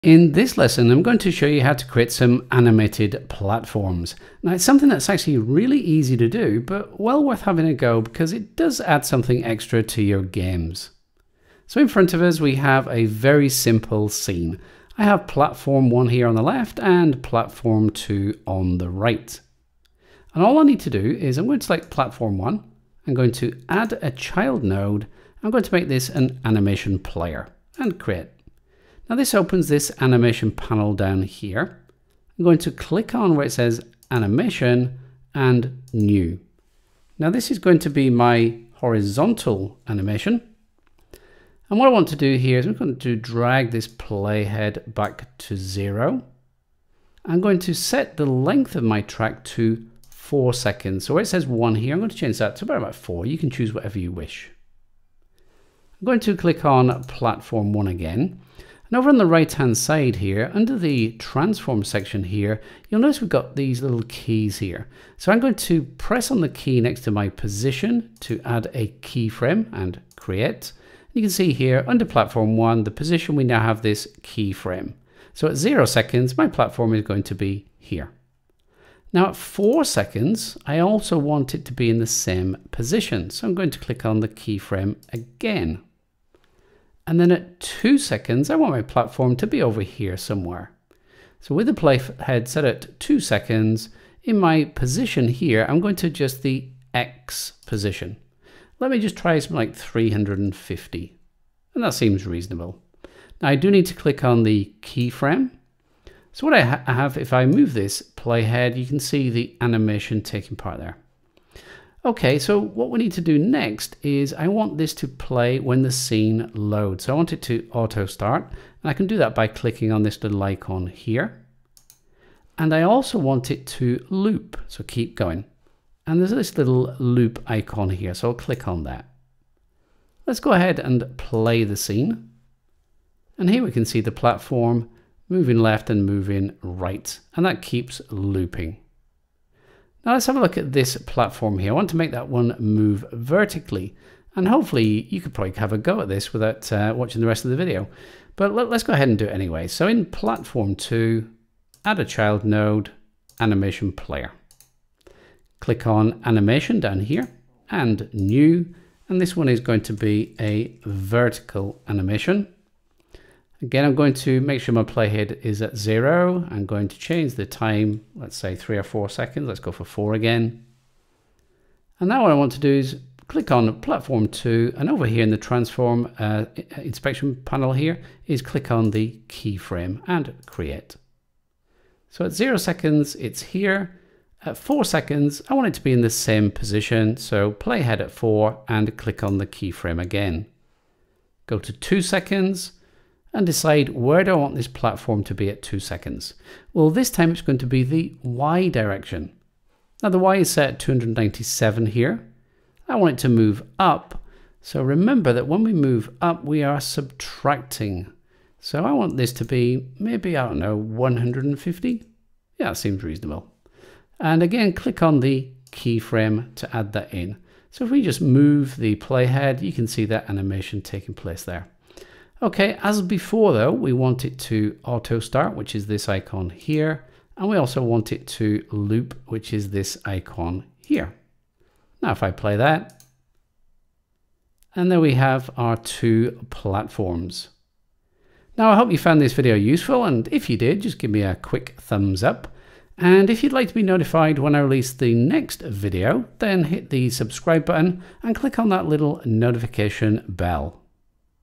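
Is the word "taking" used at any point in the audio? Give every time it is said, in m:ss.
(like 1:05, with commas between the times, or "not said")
1:50, 3:40.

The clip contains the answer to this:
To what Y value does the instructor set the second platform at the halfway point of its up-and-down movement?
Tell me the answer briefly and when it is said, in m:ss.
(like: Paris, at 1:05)
150, at 3:30.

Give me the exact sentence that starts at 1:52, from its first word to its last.
Okay, so what we need to do next is I want this to play when the scene loads.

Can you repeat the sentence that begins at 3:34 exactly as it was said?
And again, click on the keyframe to add that in.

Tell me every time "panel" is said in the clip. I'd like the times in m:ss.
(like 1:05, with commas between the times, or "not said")
0:30, 2:57.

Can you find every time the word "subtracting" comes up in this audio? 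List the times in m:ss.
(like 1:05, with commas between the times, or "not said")
3:26.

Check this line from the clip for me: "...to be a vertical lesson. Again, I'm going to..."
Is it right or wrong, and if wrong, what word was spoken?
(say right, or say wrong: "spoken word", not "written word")
wrong: "animation", not "lesson".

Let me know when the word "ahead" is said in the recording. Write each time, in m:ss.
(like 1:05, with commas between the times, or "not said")
2:10, 2:28.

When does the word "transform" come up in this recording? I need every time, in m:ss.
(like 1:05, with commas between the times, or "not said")
1:01, 2:55.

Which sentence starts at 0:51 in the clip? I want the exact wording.
So where it says one here, I'm going to change that to about four.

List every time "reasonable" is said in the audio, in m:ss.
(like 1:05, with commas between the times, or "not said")
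1:42, 3:33.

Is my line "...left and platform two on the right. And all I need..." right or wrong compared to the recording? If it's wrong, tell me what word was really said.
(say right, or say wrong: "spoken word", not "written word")
right.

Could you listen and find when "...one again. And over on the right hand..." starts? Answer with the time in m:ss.
0:57.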